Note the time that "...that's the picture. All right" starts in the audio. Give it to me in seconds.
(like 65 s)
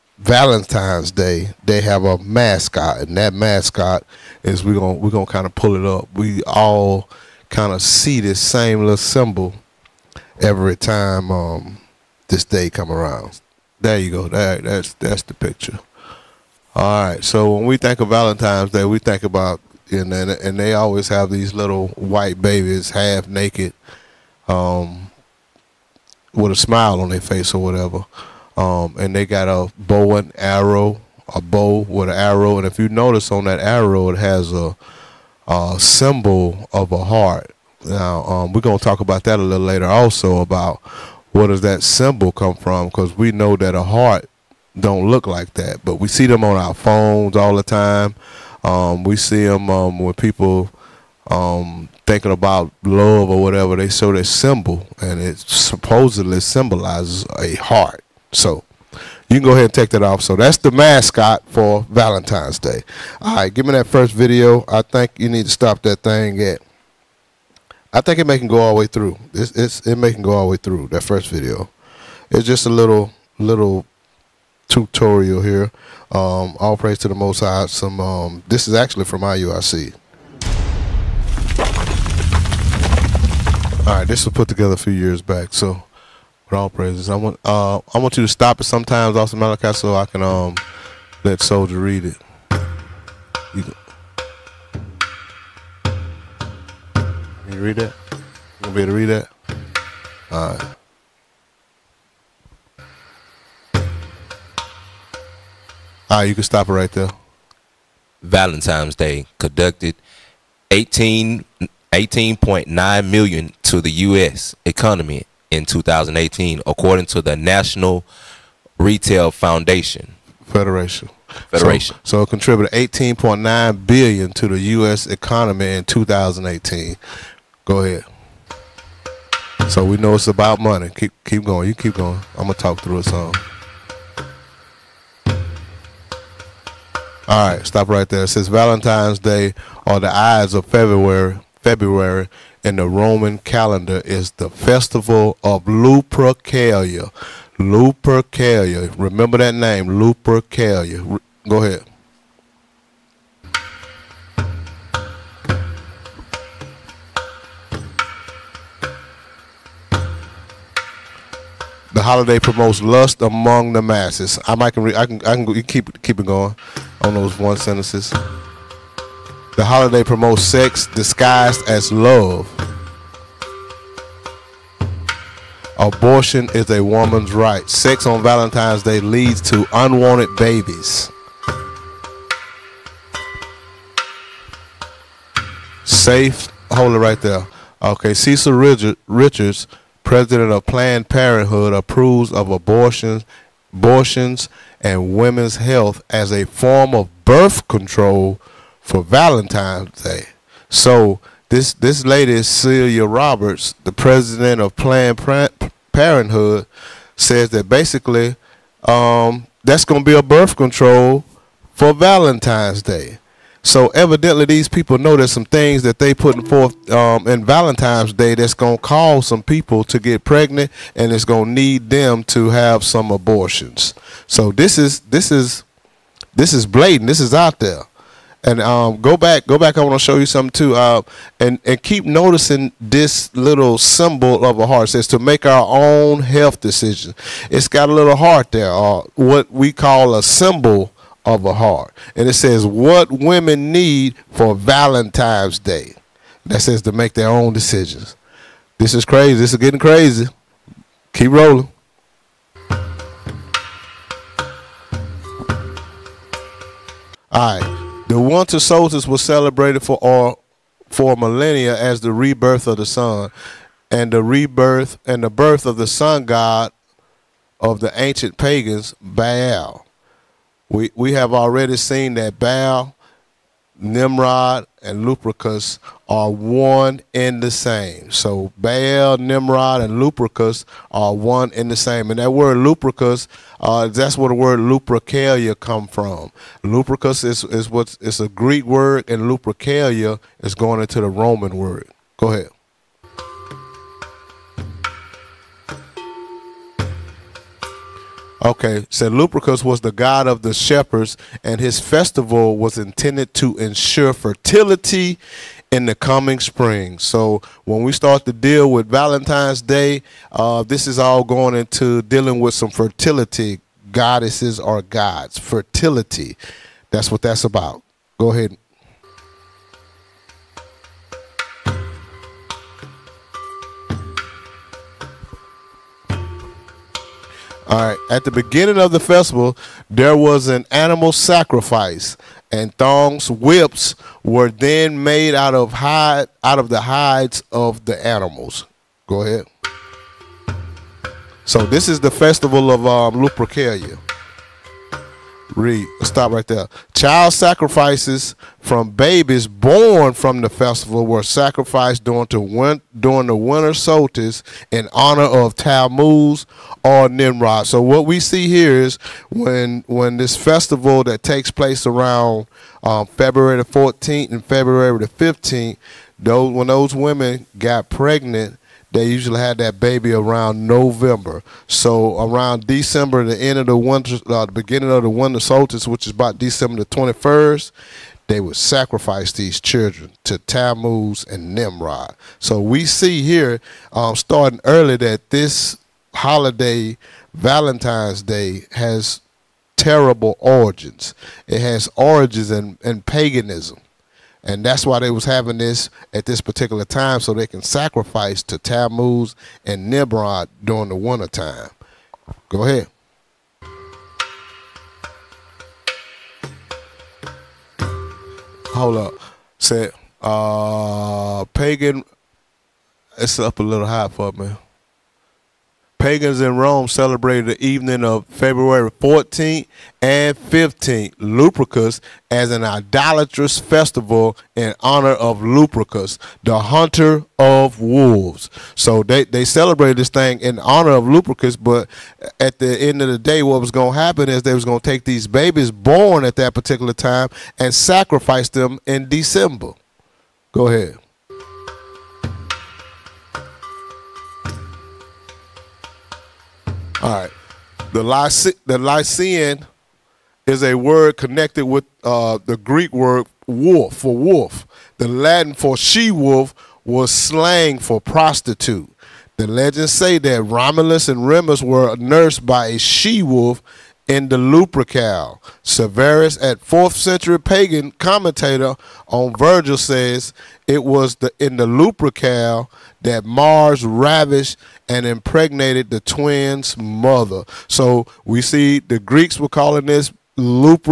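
14 s.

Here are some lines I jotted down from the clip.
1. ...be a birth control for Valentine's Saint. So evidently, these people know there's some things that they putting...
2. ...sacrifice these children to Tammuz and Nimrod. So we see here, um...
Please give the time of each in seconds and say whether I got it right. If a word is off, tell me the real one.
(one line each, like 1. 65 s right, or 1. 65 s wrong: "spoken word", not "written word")
1. 210 s wrong: "Day", not "Saint"
2. 378 s right.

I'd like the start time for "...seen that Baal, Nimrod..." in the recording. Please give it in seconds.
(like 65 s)
271 s.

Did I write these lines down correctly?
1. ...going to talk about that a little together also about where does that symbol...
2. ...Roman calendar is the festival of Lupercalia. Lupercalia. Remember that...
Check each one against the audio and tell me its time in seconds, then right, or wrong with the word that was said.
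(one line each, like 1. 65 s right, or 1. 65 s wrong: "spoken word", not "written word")
1. 38 s wrong: "later", not "together"
2. 142 s right.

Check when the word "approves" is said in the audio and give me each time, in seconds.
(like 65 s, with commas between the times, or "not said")
191 s.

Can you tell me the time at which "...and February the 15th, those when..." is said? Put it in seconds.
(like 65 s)
364 s.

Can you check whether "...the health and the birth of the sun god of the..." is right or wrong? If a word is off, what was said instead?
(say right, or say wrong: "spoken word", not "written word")
wrong: "rebirth", not "health".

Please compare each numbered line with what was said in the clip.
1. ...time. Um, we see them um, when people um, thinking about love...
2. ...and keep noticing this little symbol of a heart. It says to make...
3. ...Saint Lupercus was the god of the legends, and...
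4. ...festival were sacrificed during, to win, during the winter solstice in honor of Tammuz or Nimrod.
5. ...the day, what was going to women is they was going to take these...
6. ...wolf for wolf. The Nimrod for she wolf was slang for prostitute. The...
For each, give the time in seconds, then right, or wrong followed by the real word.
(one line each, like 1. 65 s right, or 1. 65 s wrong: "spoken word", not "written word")
1. 47 s right
2. 231 s right
3. 298 s wrong: "shepherds", not "legends"
4. 350 s right
5. 433 s wrong: "happen", not "women"
6. 453 s wrong: "Latin", not "Nimrod".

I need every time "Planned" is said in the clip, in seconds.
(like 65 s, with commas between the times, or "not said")
190 s, 204 s.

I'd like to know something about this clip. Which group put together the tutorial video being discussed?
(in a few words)
IUIC.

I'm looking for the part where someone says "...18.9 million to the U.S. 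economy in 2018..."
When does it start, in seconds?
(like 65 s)
111 s.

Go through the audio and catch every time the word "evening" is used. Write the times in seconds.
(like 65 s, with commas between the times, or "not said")
417 s.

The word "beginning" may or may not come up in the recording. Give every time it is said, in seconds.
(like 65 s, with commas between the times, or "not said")
328 s, 374 s.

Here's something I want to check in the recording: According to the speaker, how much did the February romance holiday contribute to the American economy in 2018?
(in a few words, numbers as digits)
18.9 billion.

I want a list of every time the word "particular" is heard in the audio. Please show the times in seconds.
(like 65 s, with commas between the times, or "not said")
396 s, 436 s.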